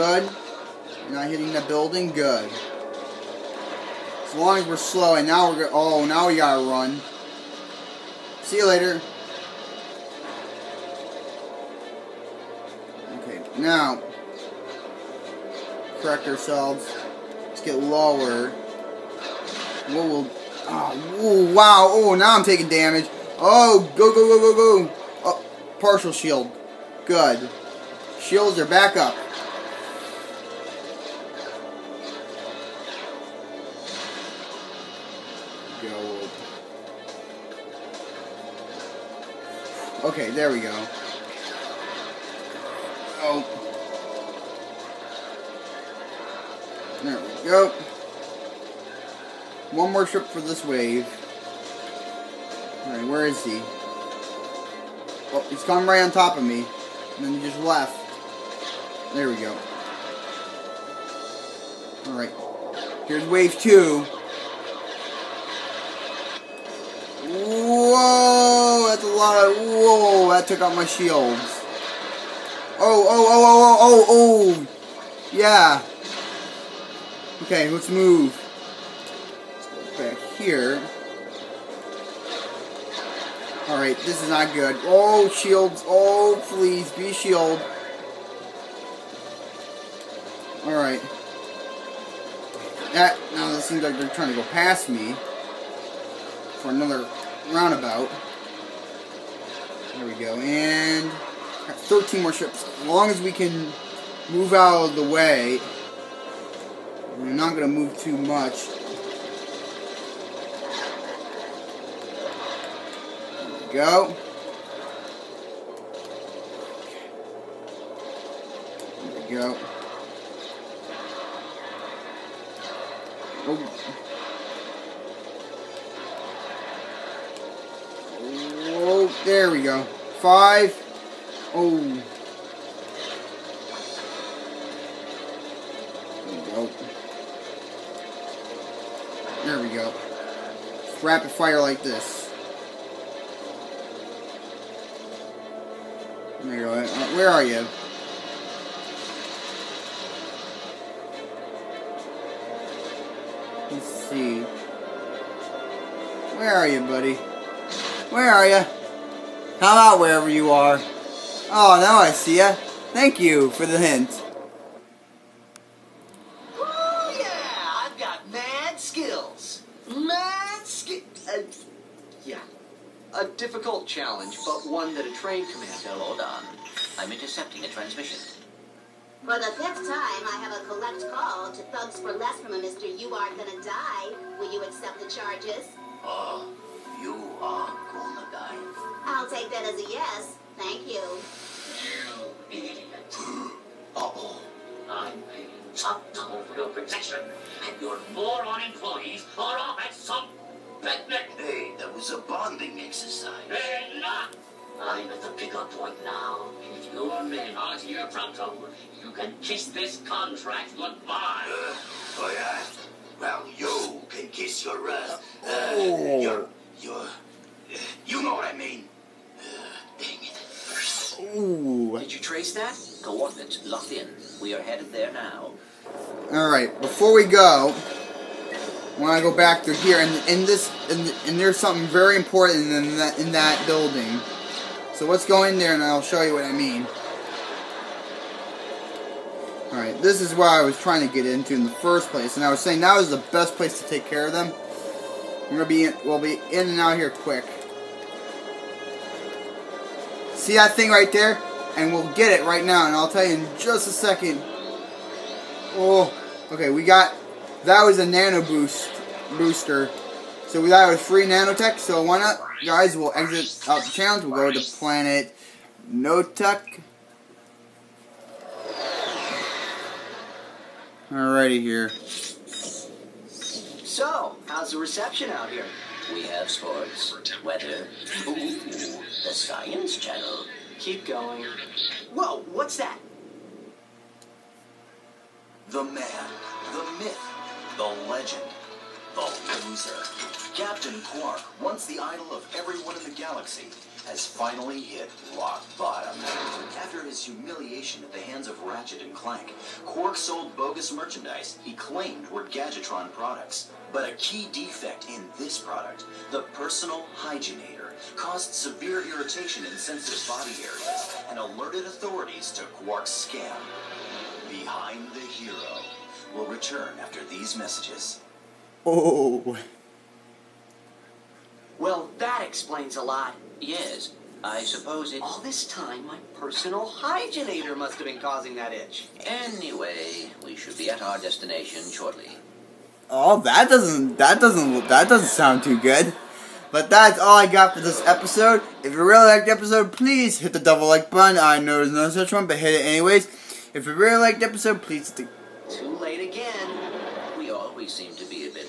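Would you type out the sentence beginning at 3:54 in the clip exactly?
So let's go in there, and I'll show you what I mean.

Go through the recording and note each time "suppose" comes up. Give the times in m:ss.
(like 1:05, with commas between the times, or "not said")
5:24.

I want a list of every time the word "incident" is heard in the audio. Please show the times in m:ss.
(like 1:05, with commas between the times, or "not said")
not said.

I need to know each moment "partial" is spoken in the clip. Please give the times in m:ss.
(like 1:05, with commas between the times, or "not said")
0:25.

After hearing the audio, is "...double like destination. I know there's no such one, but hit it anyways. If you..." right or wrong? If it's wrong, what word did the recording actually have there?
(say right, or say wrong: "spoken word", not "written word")
wrong: "button", not "destination".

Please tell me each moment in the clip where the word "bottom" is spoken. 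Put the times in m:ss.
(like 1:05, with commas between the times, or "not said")
4:55.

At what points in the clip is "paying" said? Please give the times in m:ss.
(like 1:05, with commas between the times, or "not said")
3:15.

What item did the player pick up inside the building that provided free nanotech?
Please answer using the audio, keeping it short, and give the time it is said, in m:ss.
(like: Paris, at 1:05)
Nano boost booster, at 4:18.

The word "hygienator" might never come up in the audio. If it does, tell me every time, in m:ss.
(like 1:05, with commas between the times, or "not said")
5:07, 5:26.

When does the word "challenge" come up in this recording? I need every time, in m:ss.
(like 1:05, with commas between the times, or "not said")
2:53, 4:23.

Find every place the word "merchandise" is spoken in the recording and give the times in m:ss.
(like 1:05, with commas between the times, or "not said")
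5:00.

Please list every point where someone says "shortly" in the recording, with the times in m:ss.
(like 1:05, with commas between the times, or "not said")
5:31.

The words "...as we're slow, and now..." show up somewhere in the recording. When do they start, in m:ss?
0:04.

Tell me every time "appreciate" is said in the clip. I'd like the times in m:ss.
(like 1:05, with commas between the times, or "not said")
not said.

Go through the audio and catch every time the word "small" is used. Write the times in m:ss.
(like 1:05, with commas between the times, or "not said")
not said.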